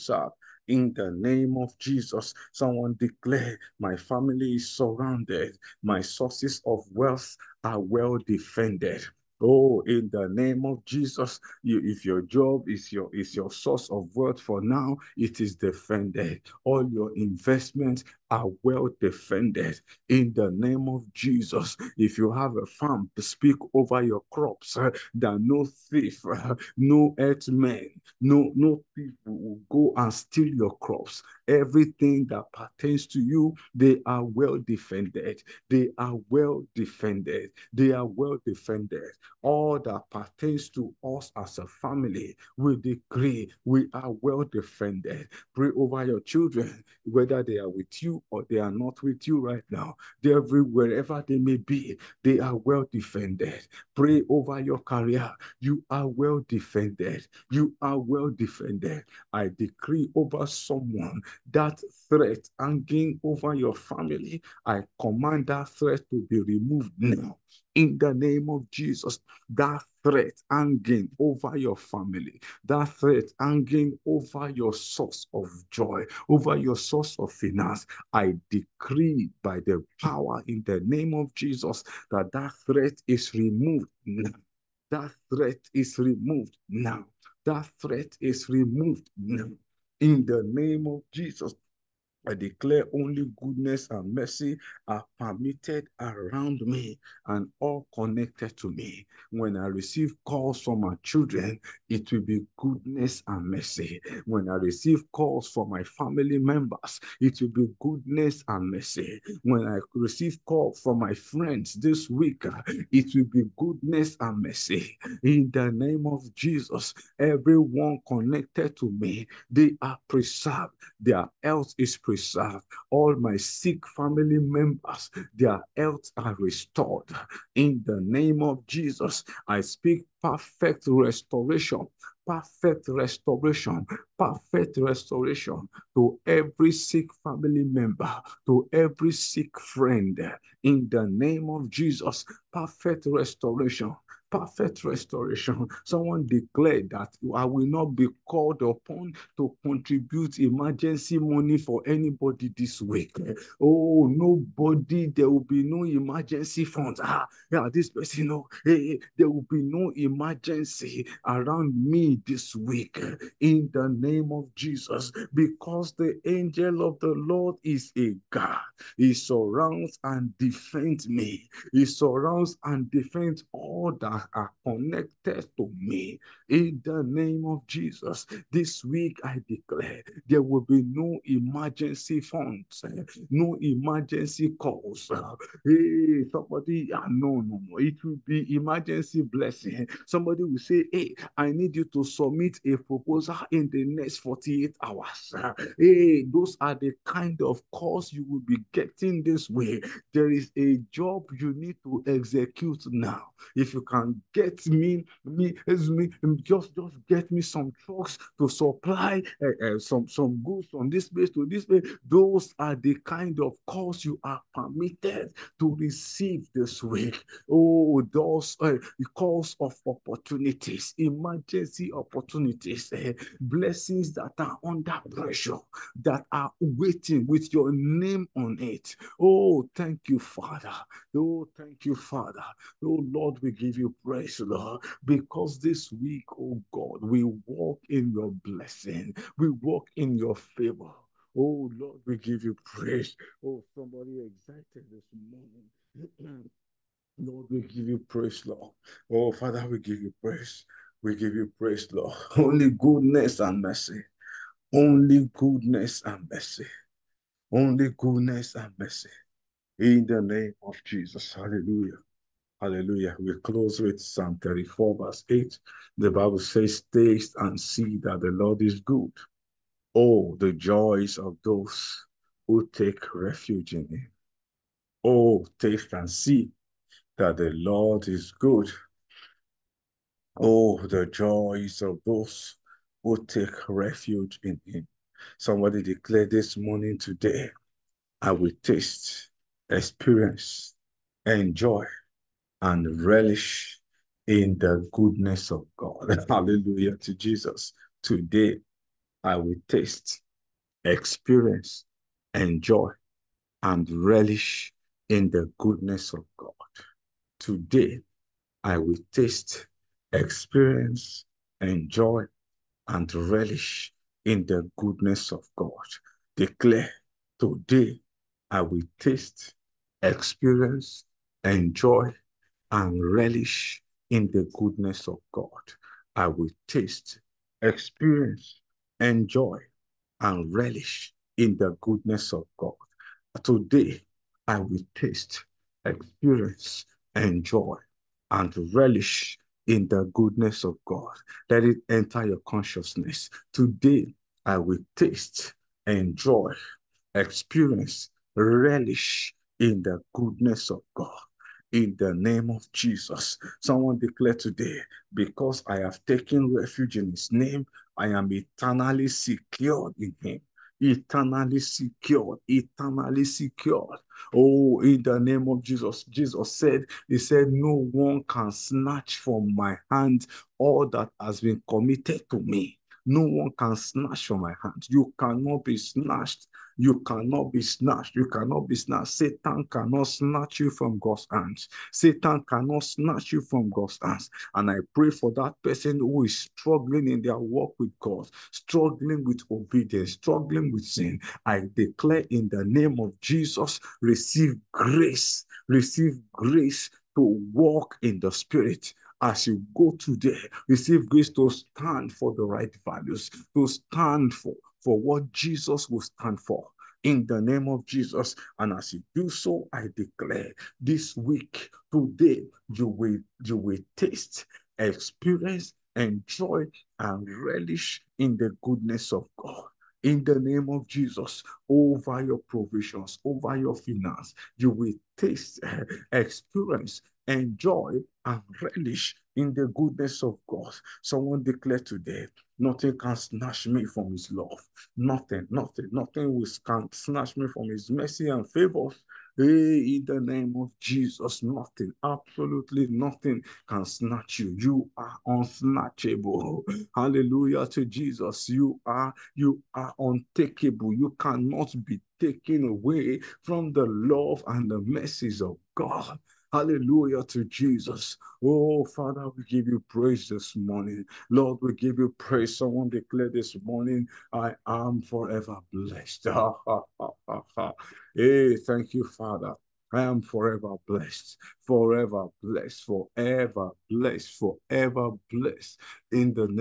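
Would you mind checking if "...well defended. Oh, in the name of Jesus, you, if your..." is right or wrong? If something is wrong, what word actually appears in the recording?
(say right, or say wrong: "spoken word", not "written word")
right.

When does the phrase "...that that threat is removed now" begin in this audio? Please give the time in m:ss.
1:22.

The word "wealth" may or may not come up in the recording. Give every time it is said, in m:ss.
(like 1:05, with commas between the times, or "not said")
0:06, 0:14.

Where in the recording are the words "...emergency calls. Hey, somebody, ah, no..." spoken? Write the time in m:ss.
3:03.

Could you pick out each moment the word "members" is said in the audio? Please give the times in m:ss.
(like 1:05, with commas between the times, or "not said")
1:46, 2:04, 2:17.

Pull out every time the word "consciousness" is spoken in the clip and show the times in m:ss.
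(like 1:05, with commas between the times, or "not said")
5:42.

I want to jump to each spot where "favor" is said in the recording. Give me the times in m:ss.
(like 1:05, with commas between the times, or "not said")
4:00, 7:18.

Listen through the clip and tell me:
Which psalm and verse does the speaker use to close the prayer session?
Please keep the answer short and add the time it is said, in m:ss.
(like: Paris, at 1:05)
Psalm 34:8, at 4:23.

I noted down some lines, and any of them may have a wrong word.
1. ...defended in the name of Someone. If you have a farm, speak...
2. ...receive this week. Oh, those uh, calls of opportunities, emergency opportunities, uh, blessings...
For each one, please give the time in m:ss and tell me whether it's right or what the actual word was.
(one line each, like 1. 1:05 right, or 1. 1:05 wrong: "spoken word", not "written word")
1. 0:19 wrong: "Jesus", not "Someone"
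2. 3:35 right.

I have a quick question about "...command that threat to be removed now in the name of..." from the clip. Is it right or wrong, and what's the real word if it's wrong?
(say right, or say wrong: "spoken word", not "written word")
right.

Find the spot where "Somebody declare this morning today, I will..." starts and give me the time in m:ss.
4:45.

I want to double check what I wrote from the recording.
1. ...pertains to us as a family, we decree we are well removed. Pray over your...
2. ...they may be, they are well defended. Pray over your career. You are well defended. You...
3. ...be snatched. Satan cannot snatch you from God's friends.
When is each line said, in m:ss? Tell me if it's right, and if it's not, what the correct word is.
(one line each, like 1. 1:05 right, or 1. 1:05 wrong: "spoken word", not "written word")
1. 0:40 wrong: "defended", not "removed"
2. 0:51 right
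3. 6:18 wrong: "hands", not "friends".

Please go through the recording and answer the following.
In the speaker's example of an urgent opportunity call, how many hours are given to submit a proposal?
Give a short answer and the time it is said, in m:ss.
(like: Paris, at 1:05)
48, at 3:14.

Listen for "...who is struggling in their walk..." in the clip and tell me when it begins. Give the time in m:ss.
6:25.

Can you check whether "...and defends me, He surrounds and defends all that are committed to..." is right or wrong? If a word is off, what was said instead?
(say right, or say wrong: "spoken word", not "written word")
wrong: "connected", not "committed".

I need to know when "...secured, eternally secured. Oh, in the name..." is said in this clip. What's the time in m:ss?
6:01.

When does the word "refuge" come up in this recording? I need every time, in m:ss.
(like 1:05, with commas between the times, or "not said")
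4:33, 4:43, 5:56.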